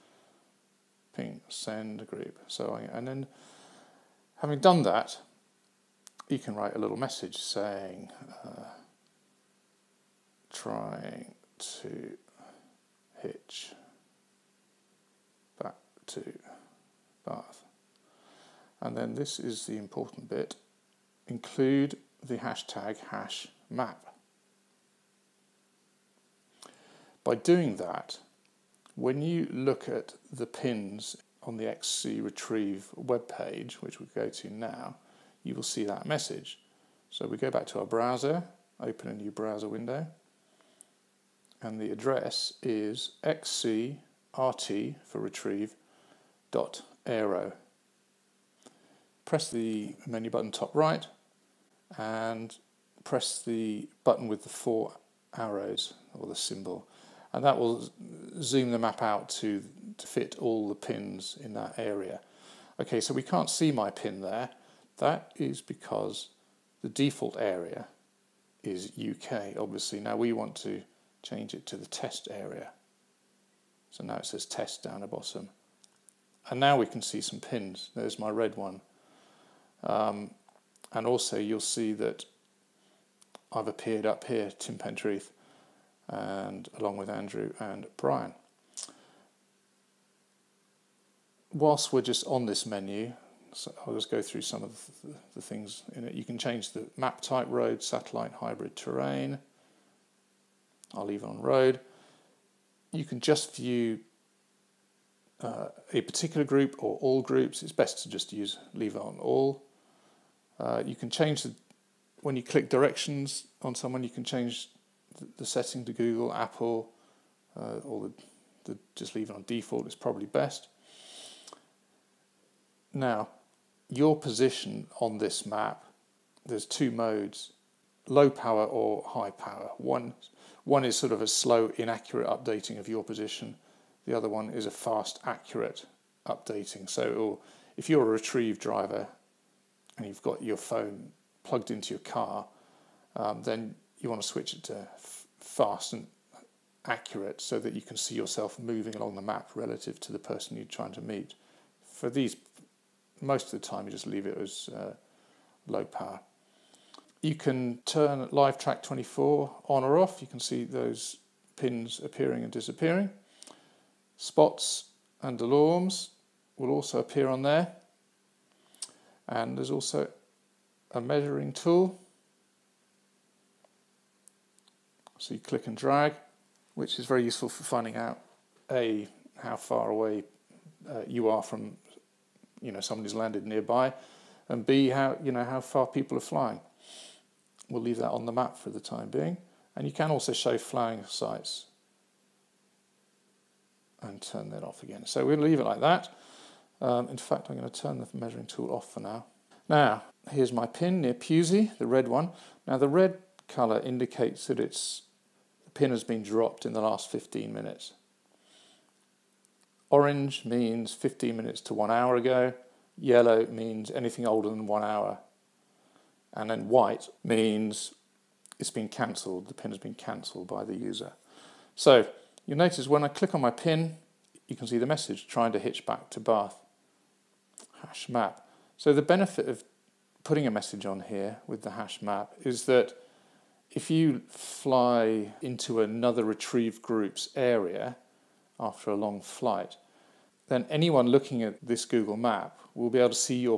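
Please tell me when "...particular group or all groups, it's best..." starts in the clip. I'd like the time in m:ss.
1:46.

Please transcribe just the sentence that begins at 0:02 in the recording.
So I, and then having done that, you can write a little message saying, uh, trying to hitch back to Bath.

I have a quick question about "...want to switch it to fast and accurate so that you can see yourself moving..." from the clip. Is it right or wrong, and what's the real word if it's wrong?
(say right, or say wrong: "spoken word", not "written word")
right.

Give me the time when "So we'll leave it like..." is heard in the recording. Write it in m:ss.
3:15.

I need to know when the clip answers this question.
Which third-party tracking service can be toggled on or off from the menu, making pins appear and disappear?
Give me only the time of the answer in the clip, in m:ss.
2:38.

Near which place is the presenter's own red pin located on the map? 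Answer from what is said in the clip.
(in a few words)
Pusey.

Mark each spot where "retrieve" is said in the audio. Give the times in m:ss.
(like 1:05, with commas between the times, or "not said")
0:32, 0:45, 2:18, 3:56.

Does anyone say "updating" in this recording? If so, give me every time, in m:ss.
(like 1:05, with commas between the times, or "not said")
2:12, 2:16.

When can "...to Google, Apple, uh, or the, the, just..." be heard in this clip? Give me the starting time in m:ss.
1:55.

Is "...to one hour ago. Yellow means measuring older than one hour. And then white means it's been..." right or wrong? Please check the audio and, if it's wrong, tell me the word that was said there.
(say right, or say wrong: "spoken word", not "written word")
wrong: "anything", not "measuring".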